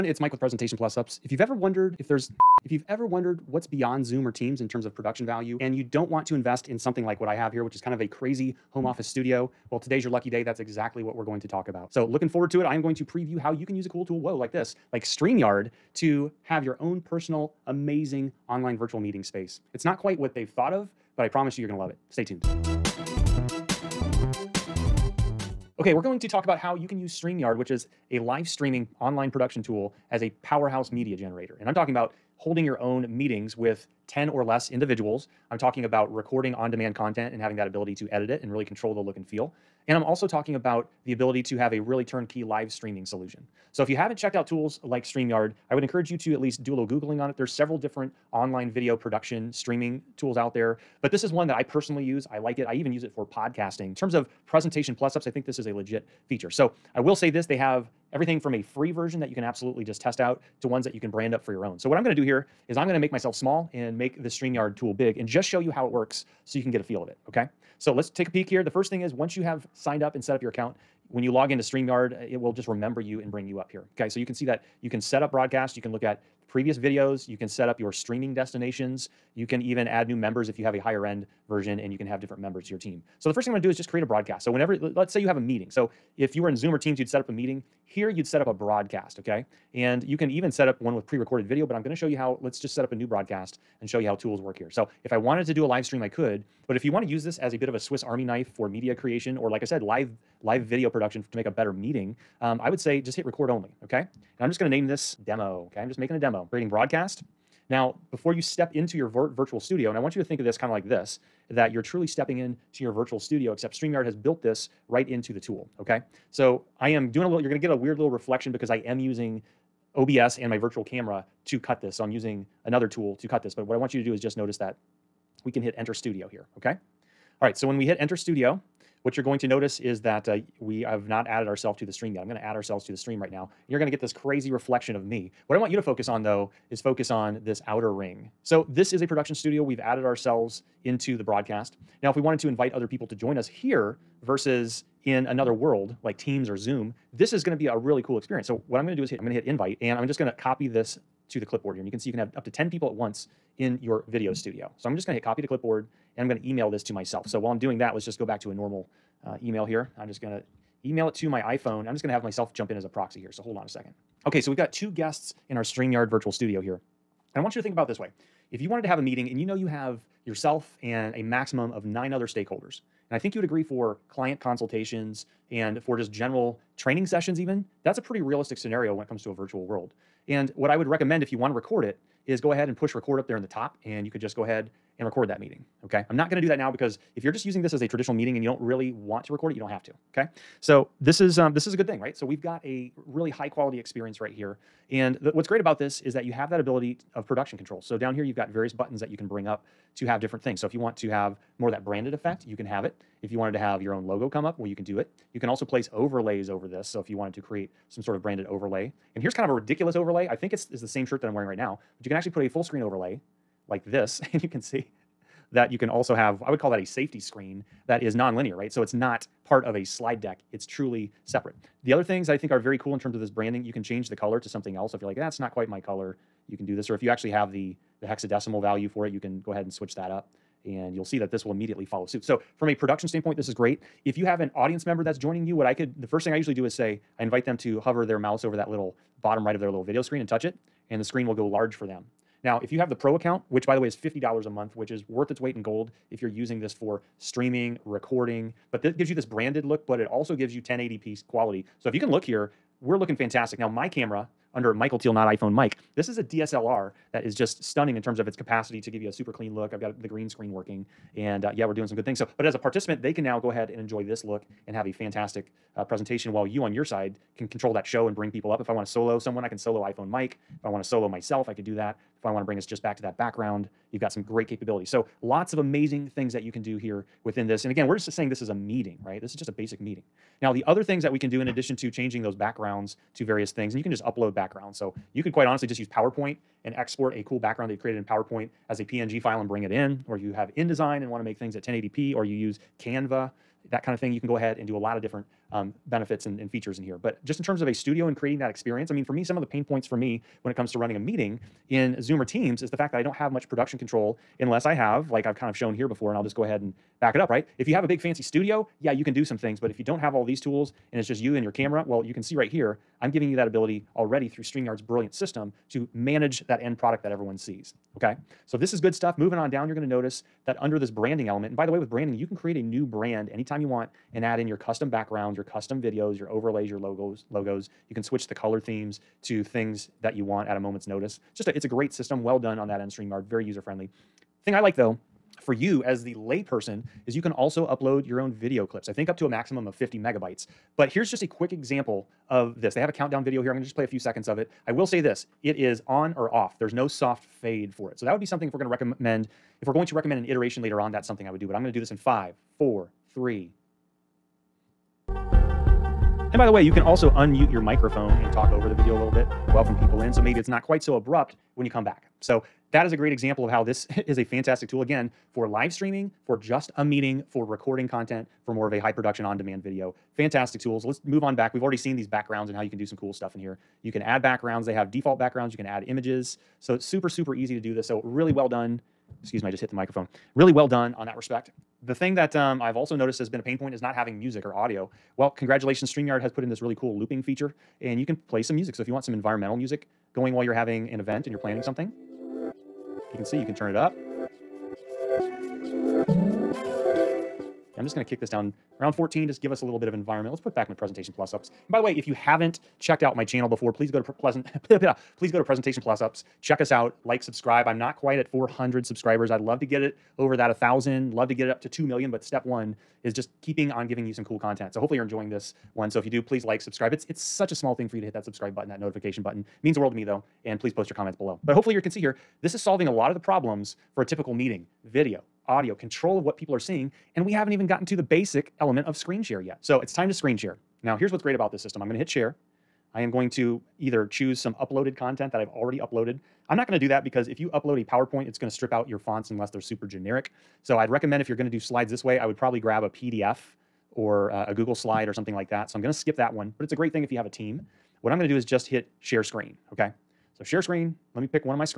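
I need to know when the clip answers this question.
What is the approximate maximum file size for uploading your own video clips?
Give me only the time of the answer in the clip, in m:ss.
5:39.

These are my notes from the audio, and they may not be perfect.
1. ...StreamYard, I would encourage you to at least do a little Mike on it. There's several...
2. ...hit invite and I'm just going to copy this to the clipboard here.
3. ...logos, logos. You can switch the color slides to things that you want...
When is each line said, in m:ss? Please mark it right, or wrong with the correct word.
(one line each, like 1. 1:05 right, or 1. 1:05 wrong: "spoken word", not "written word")
1. 0:45 wrong: "Googling", not "Mike"
2. 2:29 right
3. 5:26 wrong: "themes", not "slides".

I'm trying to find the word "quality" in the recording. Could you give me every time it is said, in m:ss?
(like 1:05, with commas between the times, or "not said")
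3:13, 4:11.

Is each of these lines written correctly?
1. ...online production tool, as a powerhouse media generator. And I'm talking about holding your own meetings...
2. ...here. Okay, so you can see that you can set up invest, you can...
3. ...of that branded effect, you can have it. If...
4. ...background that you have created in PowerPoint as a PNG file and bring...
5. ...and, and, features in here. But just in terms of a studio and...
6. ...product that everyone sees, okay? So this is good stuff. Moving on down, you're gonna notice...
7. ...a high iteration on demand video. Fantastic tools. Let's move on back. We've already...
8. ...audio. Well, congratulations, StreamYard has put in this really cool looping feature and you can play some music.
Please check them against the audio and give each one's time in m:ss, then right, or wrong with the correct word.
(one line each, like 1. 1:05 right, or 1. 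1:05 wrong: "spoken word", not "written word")
1. 0:29 right
2. 1:13 wrong: "broadcast", not "invest"
3. 3:21 right
4. 4:47 right
5. 4:56 right
6. 5:16 right
7. 6:08 wrong: "production", not "iteration"
8. 6:24 right.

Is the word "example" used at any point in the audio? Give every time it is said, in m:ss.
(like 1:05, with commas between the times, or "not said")
5:41, 6:03.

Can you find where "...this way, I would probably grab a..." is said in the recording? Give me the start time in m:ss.
7:21.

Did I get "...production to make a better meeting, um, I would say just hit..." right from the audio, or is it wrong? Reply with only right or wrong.
right.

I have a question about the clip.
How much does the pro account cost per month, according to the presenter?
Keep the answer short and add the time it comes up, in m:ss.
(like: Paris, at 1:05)
$50, at 4:03.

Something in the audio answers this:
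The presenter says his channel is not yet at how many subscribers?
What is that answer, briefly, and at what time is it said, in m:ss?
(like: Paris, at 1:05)
400, at 6:48.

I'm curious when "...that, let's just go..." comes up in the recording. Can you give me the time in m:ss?
2:37.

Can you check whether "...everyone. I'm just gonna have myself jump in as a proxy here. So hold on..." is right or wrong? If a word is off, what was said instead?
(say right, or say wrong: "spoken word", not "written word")
wrong: "iPhone", not "everyone".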